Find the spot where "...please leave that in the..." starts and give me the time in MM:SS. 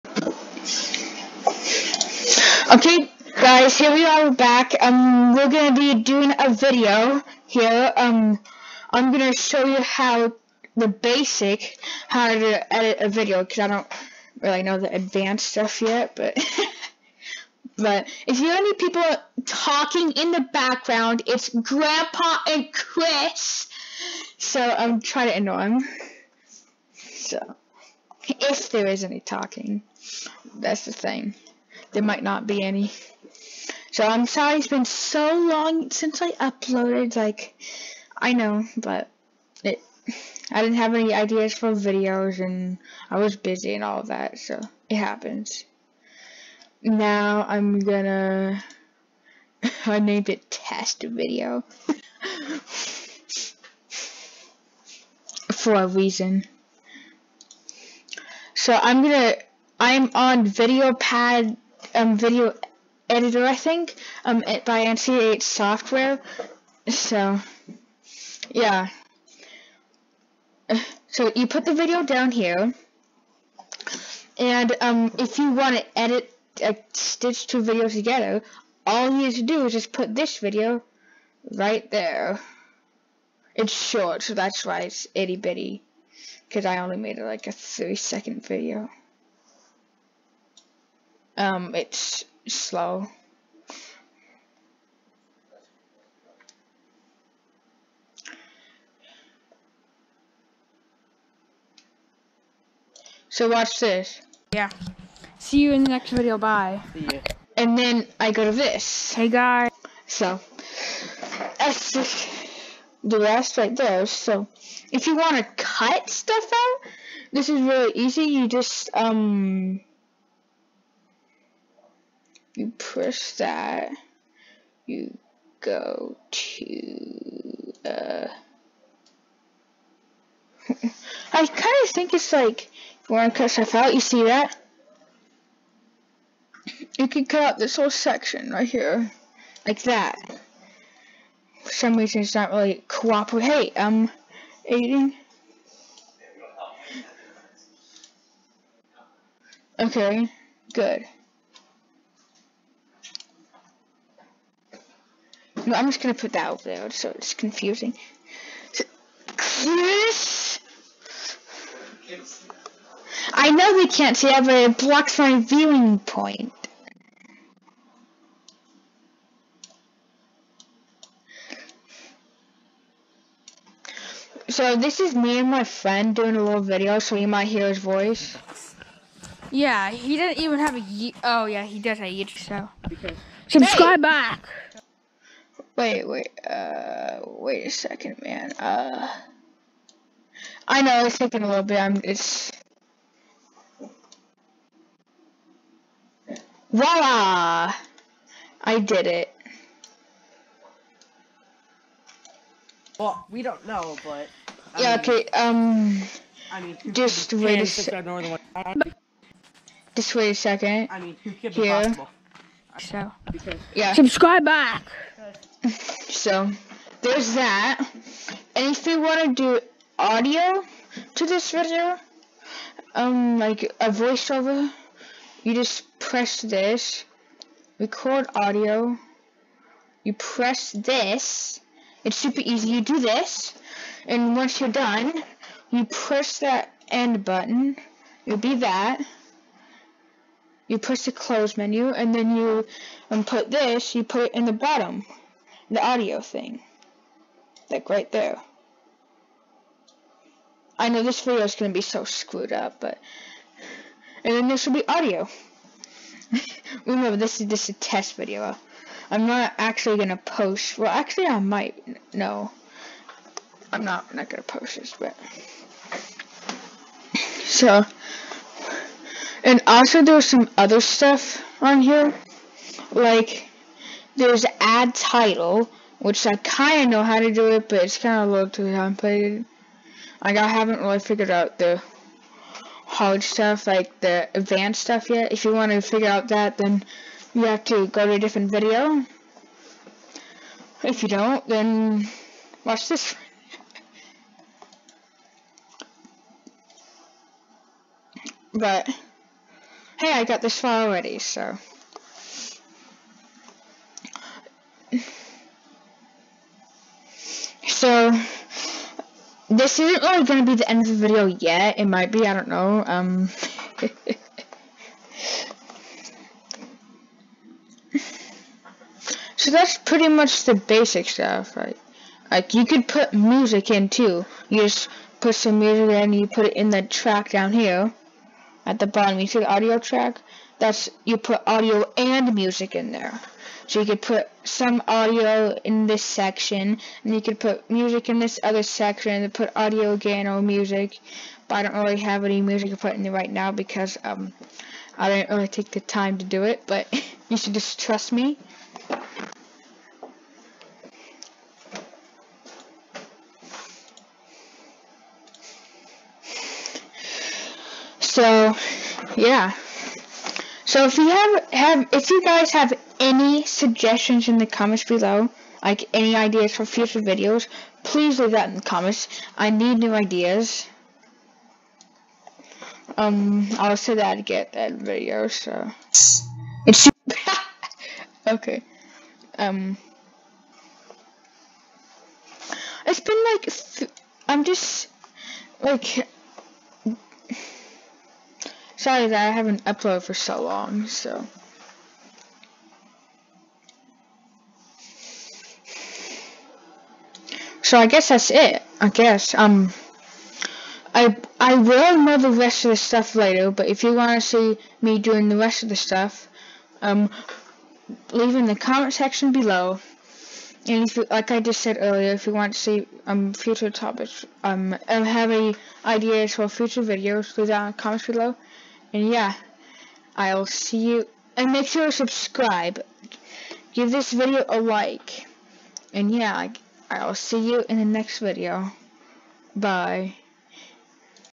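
06:07.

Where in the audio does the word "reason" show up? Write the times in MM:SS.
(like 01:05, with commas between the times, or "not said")
00:55, 02:21.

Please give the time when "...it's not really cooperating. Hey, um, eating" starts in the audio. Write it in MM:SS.
02:22.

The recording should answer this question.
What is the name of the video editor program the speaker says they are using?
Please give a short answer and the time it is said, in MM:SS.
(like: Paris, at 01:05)
VideoPad, at 01:00.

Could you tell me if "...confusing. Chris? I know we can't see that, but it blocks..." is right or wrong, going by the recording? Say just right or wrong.
right.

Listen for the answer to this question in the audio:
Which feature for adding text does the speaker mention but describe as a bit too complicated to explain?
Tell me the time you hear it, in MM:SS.
04:34.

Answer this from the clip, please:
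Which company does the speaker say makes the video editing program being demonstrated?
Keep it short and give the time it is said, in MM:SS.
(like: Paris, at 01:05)
NCH Software, at 01:04.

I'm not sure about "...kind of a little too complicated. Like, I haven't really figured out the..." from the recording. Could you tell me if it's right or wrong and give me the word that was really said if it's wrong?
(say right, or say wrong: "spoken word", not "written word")
right.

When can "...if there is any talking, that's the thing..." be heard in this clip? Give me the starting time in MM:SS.
00:28.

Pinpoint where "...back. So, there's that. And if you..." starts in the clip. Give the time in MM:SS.
03:34.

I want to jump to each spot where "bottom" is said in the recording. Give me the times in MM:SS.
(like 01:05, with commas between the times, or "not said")
04:04, 05:28.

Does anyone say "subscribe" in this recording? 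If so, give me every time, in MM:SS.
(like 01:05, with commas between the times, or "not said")
03:03, 03:33, 07:01.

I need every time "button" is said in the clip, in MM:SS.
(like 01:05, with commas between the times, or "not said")
03:57.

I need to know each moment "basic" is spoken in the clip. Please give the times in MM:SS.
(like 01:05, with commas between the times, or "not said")
00:10, 05:20.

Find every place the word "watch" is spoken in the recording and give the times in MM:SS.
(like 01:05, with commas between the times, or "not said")
01:43, 04:52.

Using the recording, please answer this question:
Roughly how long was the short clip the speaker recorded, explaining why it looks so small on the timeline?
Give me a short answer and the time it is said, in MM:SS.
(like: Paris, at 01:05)
30 seconds, at 01:27.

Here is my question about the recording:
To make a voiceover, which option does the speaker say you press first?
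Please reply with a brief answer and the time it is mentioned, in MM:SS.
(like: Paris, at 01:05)
record audio, at 03:47.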